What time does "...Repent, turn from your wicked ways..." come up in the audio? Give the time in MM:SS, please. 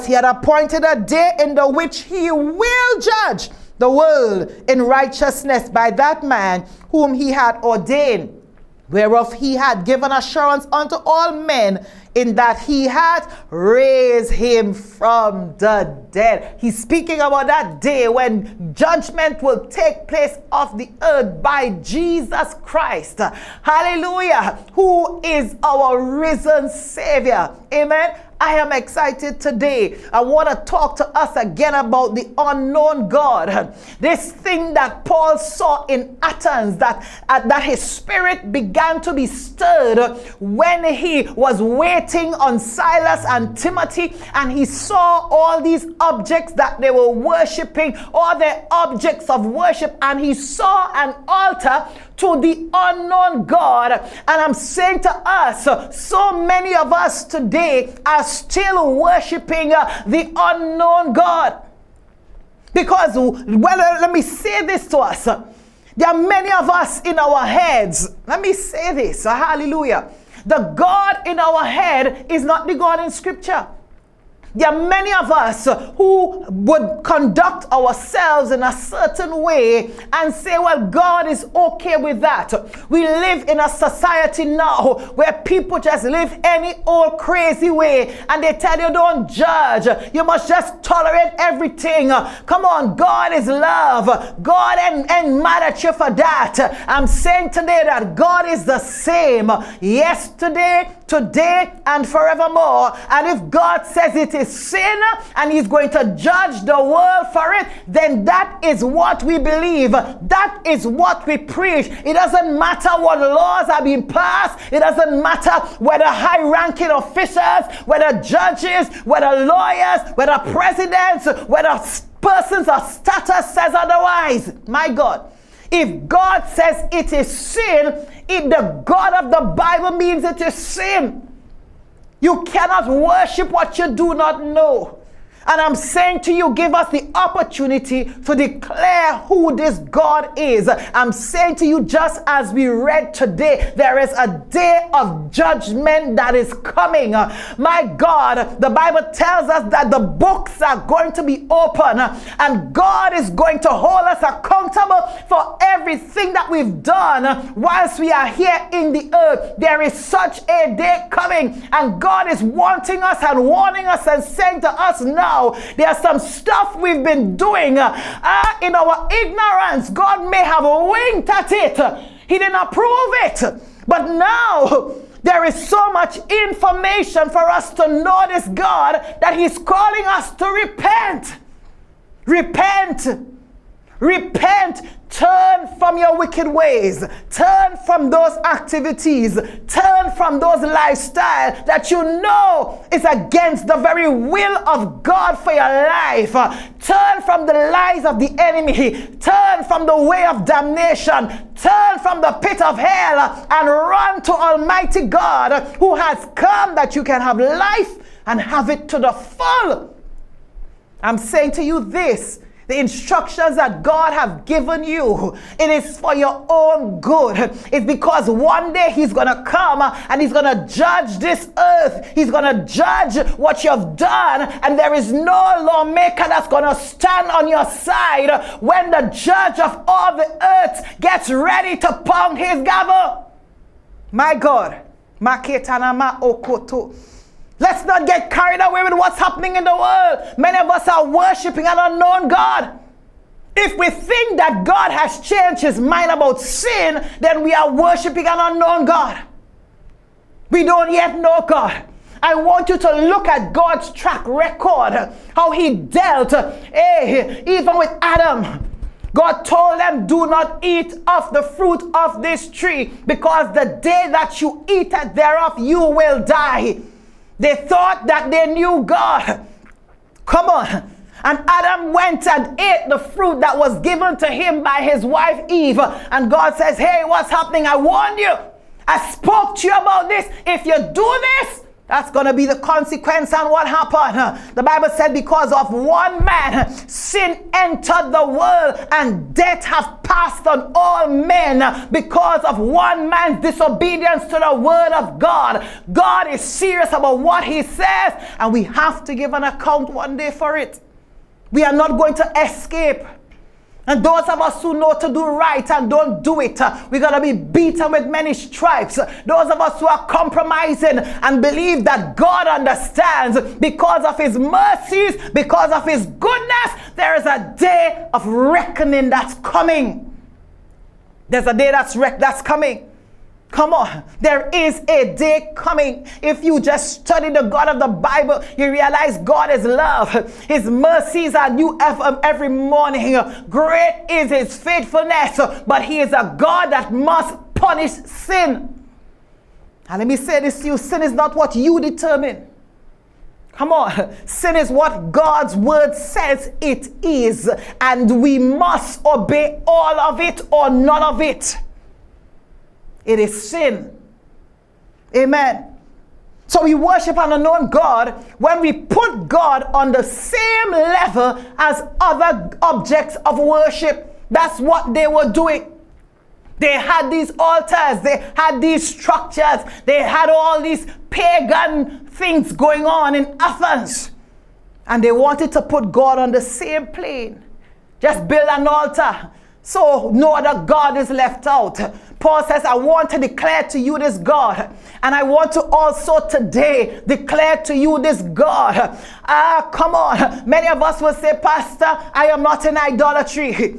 03:04.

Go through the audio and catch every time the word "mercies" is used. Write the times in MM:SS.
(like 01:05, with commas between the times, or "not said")
05:14, 05:30.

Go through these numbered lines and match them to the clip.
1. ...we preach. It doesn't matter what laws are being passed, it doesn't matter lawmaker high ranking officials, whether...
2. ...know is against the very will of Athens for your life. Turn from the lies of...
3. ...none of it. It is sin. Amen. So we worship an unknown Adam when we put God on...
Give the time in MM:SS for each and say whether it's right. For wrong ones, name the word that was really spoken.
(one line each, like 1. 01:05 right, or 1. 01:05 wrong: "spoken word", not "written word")
1. 01:51 wrong: "whether", not "lawmaker"
2. 03:12 wrong: "God", not "Athens"
3. 05:50 wrong: "God", not "Adam".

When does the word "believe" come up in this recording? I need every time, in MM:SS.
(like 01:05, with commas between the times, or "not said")
01:49, 05:11.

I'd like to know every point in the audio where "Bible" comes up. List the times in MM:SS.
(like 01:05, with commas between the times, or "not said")
02:09, 02:28, 04:44, 05:27.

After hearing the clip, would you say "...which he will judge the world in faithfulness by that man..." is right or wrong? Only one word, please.
wrong.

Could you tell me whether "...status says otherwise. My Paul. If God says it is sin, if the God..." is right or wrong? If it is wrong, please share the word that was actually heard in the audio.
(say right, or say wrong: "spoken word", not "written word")
wrong: "God", not "Paul".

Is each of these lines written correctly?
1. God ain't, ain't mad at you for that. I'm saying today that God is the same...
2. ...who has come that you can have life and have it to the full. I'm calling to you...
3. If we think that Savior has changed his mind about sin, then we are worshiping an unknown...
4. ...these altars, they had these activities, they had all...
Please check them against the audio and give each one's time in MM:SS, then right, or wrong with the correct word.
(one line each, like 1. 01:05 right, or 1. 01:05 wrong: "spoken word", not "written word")
1. 01:34 right
2. 03:25 wrong: "saying", not "calling"
3. 04:03 wrong: "God", not "Savior"
4. 06:07 wrong: "structures", not "activities".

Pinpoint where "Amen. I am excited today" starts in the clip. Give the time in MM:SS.
00:27.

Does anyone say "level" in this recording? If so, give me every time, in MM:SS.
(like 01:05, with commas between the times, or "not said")
06:00.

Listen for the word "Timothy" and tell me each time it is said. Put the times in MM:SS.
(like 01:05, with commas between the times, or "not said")
00:43.